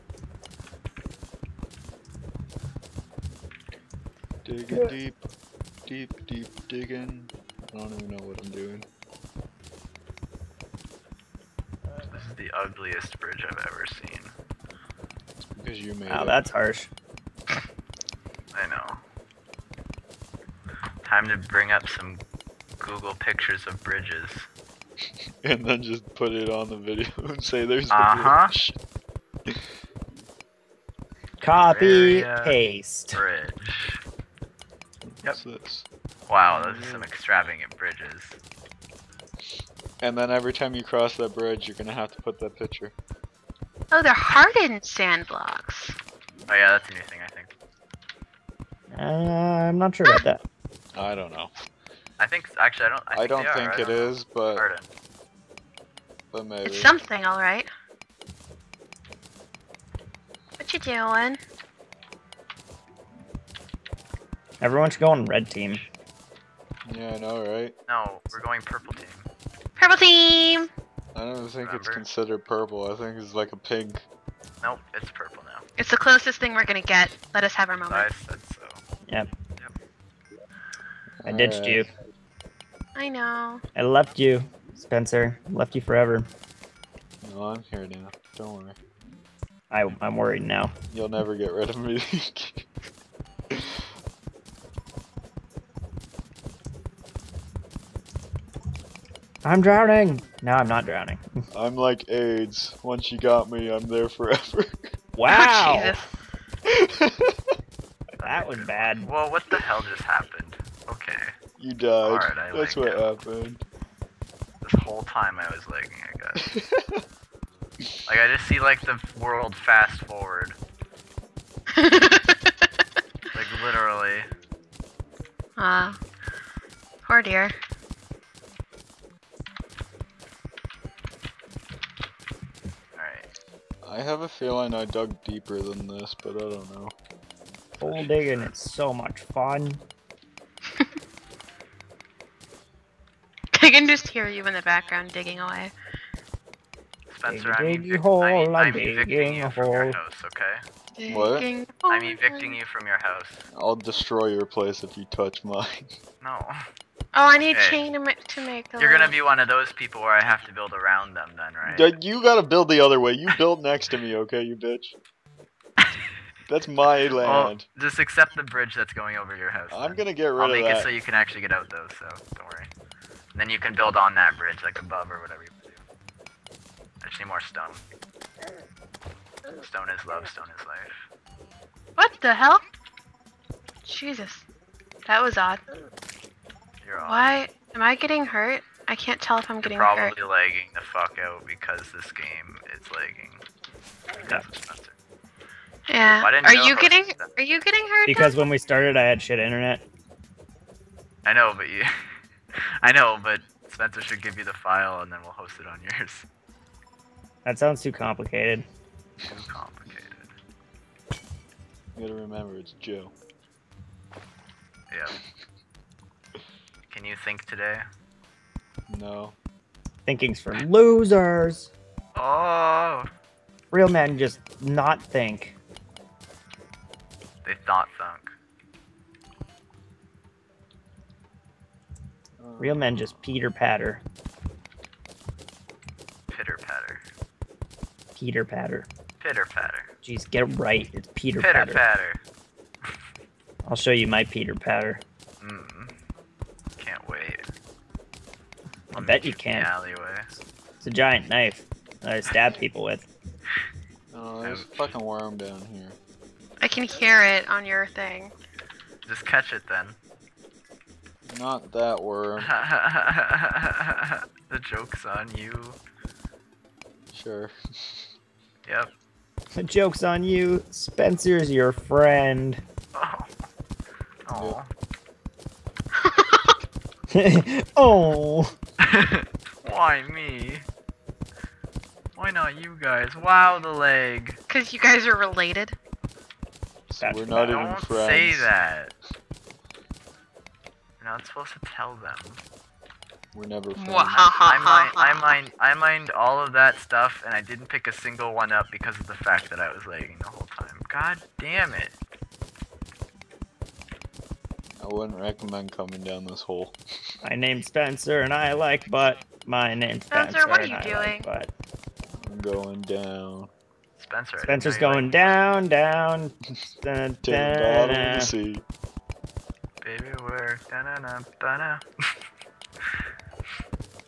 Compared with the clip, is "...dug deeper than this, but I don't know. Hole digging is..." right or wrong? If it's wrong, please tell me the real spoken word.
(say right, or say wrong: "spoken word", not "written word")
right.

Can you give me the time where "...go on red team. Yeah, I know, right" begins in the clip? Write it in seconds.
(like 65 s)
64 s.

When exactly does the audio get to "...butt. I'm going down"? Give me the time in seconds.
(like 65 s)
311 s.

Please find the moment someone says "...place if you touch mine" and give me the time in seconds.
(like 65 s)
154 s.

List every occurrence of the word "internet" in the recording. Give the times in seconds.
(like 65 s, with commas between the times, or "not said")
199 s.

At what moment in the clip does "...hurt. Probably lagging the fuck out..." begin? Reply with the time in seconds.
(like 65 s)
190 s.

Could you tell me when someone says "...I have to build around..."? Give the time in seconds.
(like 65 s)
160 s.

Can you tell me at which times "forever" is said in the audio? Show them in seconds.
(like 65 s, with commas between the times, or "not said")
85 s, 104 s.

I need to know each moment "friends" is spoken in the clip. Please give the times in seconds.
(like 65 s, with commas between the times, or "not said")
271 s, 287 s, 293 s.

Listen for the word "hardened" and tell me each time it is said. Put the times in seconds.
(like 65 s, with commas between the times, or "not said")
44 s, 54 s.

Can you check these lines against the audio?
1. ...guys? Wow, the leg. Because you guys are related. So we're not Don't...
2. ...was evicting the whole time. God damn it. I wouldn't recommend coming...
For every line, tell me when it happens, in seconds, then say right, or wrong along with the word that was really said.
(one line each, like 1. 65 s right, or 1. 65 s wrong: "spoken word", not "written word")
1. 282 s right
2. 299 s wrong: "lagging", not "evicting".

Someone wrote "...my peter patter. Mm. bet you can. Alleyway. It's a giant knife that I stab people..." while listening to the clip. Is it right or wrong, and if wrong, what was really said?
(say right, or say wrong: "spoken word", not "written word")
right.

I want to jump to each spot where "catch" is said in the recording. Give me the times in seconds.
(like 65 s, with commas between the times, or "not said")
259 s.